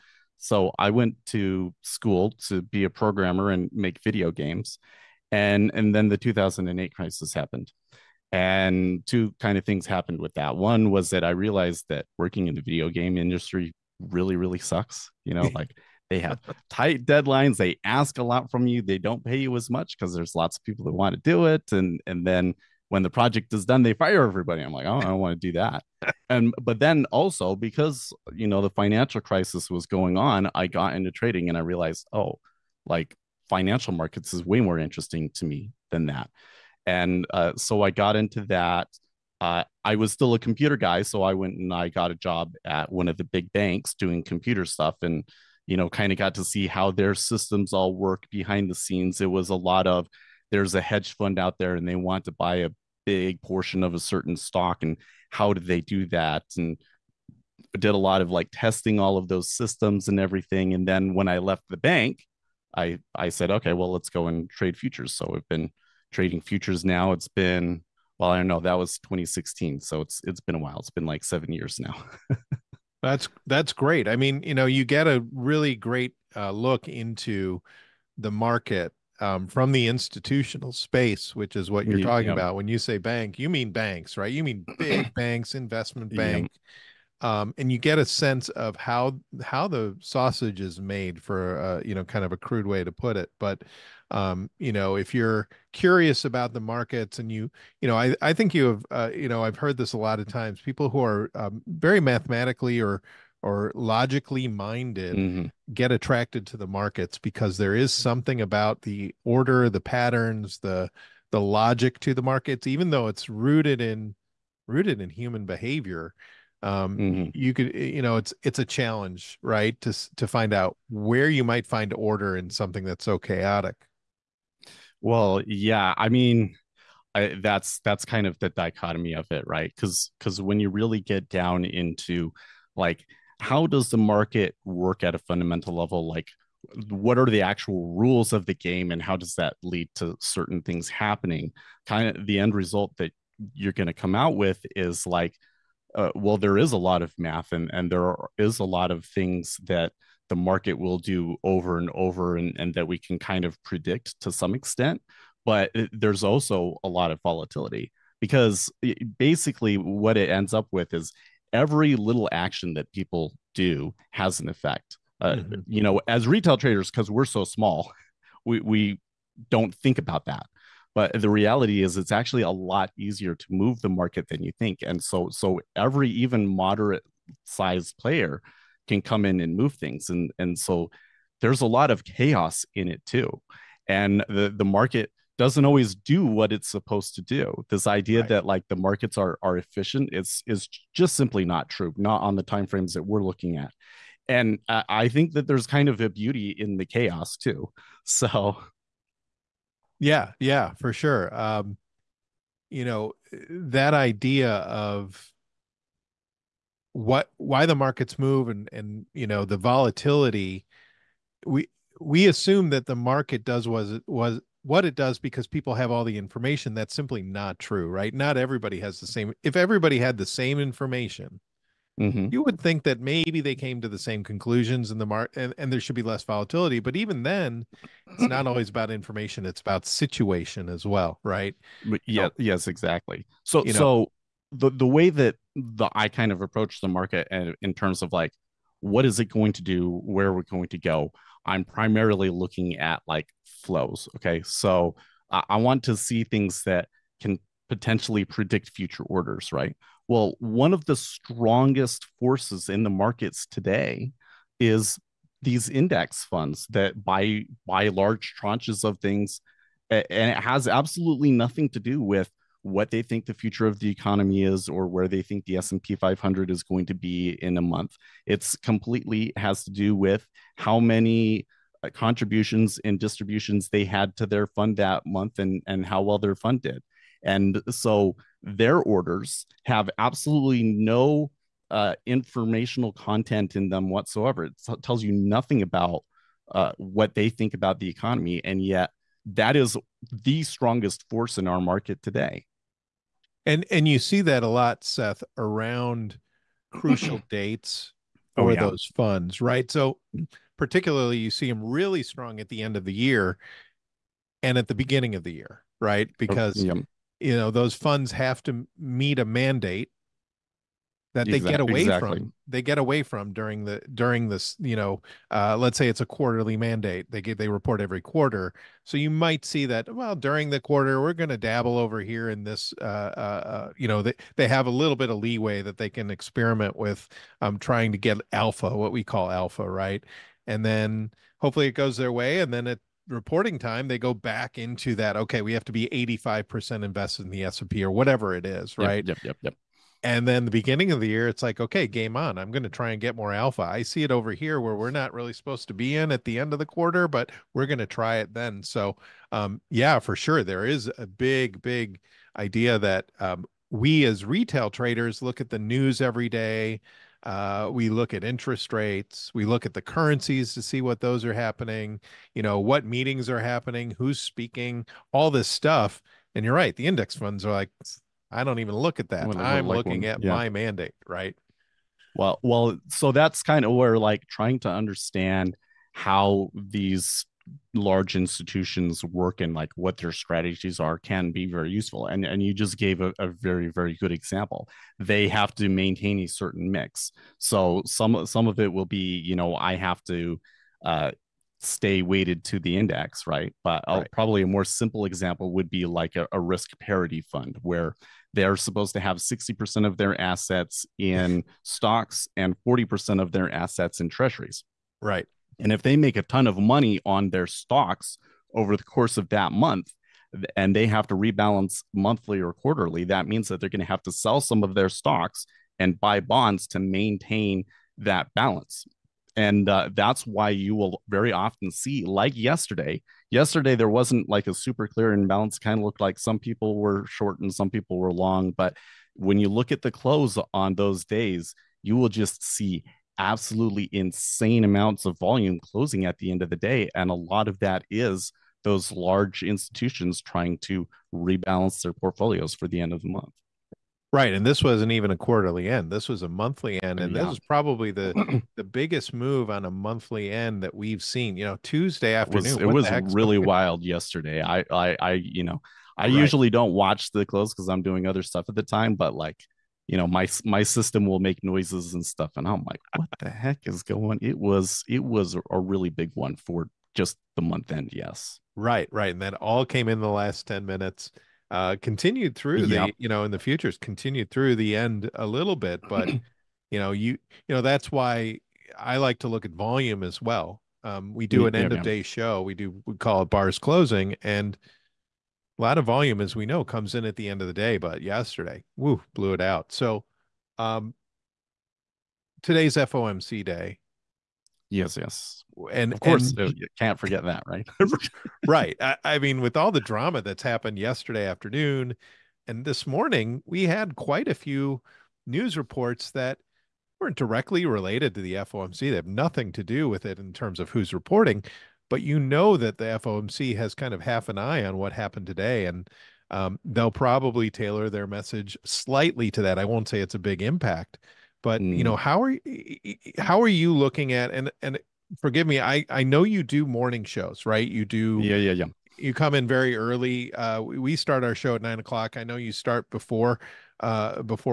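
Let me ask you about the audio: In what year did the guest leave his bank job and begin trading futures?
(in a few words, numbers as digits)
2016.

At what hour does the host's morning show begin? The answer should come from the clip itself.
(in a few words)
9 o'clock.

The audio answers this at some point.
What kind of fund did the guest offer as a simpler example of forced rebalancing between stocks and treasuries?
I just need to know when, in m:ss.
6:36.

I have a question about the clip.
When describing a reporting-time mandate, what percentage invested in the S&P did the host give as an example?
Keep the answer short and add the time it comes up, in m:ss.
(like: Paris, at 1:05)
85%, at 5:35.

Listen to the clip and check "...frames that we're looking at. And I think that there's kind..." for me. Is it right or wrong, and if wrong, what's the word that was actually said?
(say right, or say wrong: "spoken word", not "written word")
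right.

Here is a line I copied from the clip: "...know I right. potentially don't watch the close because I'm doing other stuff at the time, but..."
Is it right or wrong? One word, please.
wrong.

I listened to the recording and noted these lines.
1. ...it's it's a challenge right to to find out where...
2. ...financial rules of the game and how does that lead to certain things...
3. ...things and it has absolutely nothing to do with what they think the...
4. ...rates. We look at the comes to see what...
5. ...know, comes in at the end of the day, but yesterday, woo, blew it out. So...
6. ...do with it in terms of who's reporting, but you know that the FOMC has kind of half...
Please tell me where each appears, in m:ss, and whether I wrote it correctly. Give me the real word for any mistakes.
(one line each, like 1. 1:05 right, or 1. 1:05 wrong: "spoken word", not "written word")
1. 1:58 right
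2. 2:17 wrong: "actual", not "financial"
3. 4:18 right
4. 5:58 wrong: "currencies", not "comes"
5. 8:06 right
6. 8:29 right.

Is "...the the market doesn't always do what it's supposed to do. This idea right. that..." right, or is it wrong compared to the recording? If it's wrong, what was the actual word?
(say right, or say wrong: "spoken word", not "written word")
right.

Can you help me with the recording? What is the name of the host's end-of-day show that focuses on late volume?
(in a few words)
Bars Closing.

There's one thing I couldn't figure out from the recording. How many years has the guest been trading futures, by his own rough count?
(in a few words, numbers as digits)
7.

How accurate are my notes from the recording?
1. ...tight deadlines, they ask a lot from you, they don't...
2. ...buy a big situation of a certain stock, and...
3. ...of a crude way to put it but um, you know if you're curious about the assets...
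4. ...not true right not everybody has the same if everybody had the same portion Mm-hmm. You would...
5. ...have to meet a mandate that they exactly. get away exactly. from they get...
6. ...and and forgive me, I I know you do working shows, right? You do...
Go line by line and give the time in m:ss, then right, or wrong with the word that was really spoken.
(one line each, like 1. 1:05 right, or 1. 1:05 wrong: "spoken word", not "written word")
1. 0:16 right
2. 0:52 wrong: "portion", not "situation"
3. 1:32 wrong: "markets", not "assets"
4. 3:37 wrong: "information", not "portion"
5. 5:08 right
6. 8:44 wrong: "morning", not "working".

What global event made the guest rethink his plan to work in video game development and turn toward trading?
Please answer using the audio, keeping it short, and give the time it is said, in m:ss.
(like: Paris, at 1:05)
2008 crisis, at 0:06.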